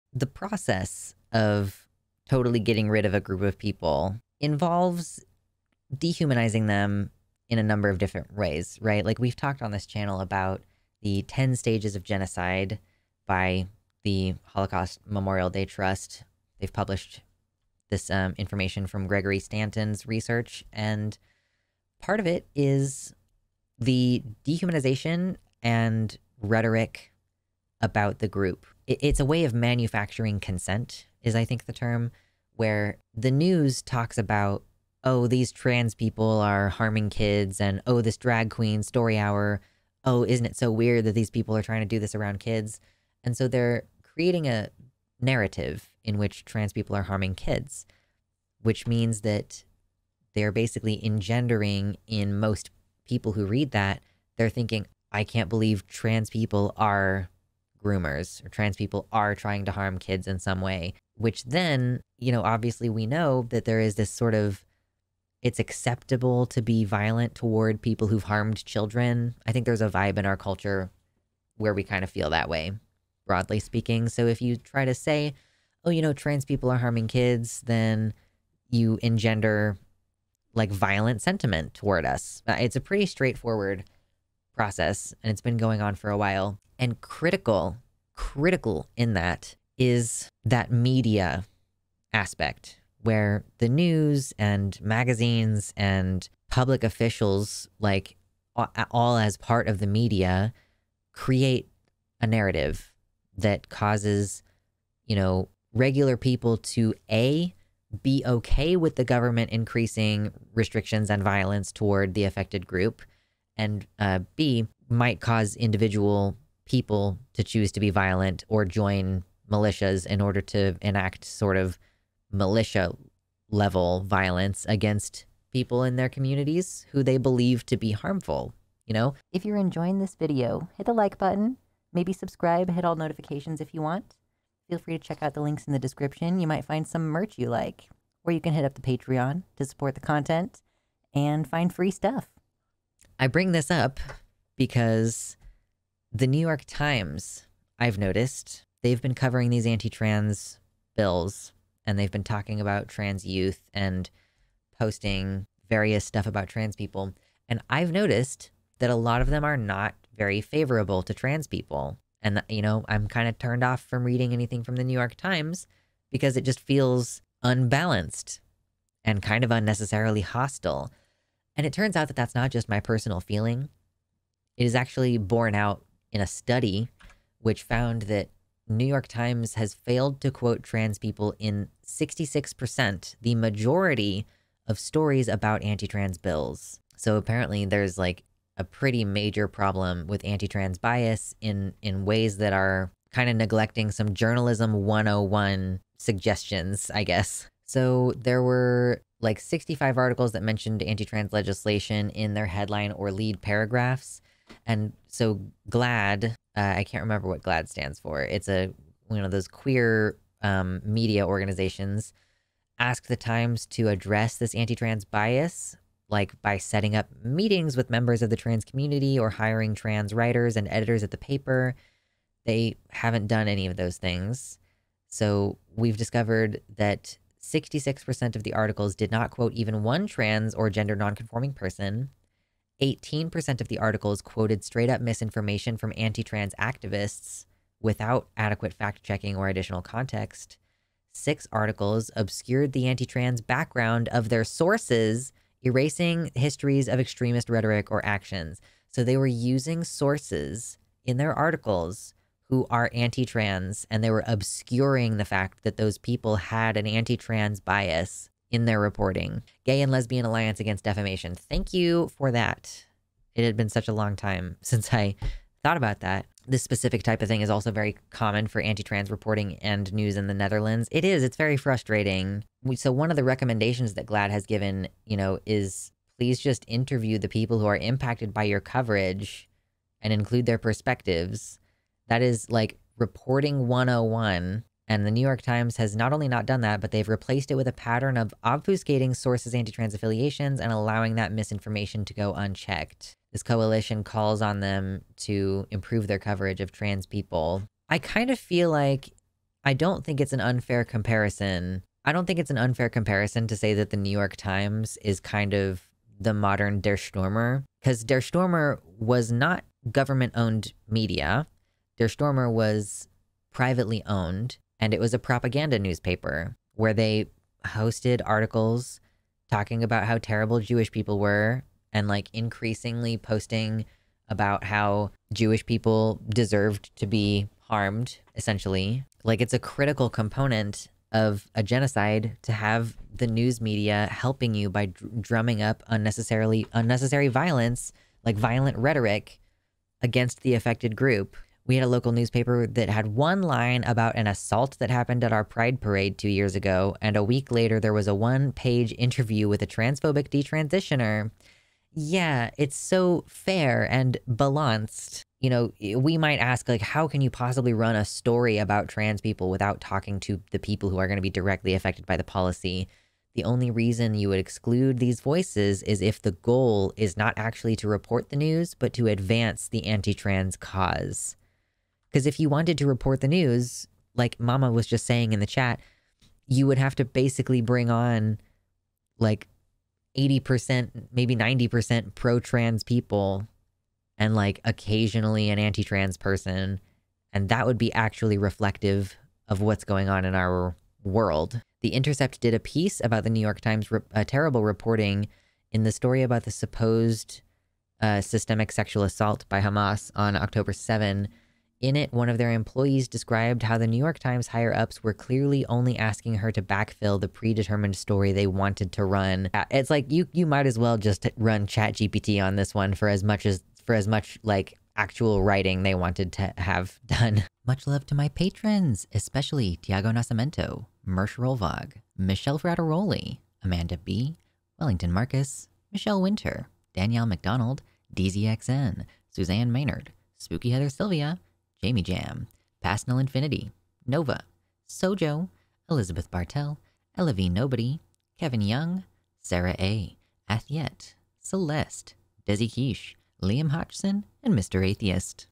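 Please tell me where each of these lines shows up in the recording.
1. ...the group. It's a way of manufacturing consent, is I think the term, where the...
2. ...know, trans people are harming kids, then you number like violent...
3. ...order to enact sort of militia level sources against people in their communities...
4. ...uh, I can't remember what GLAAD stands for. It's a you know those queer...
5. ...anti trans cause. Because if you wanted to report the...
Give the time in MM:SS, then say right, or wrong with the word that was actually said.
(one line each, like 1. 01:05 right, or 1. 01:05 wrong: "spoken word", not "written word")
1. 00:28 right
2. 01:16 wrong: "engender", not "number"
3. 02:00 wrong: "violence", not "sources"
4. 03:26 right
5. 06:09 right.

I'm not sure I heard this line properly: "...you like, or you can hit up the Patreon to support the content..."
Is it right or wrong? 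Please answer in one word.
right.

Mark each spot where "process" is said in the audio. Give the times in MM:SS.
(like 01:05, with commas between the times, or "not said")
00:00, 01:24.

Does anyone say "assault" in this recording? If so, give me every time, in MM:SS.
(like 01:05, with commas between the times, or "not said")
05:44, 06:39.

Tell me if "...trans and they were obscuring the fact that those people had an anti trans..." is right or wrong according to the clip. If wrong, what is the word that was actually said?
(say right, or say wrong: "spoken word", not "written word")
right.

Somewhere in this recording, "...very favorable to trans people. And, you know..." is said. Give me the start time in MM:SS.
02:40.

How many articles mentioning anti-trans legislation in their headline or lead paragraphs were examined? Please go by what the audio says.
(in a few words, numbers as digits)
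65.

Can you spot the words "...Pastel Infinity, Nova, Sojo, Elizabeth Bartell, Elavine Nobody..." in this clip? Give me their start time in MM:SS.
07:12.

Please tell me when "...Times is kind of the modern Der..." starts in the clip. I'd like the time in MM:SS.
05:04.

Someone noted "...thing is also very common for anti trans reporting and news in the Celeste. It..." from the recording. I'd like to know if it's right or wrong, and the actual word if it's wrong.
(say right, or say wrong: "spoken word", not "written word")
wrong: "Netherlands", not "Celeste".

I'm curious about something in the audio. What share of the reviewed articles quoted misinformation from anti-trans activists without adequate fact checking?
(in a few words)
18%.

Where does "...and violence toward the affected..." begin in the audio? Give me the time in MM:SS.
01:51.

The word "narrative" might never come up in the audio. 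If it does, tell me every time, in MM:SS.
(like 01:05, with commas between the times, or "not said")
00:45, 01:42.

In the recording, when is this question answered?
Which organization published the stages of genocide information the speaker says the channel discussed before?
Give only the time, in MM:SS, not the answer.
00:14.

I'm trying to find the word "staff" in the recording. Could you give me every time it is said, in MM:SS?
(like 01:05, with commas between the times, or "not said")
not said.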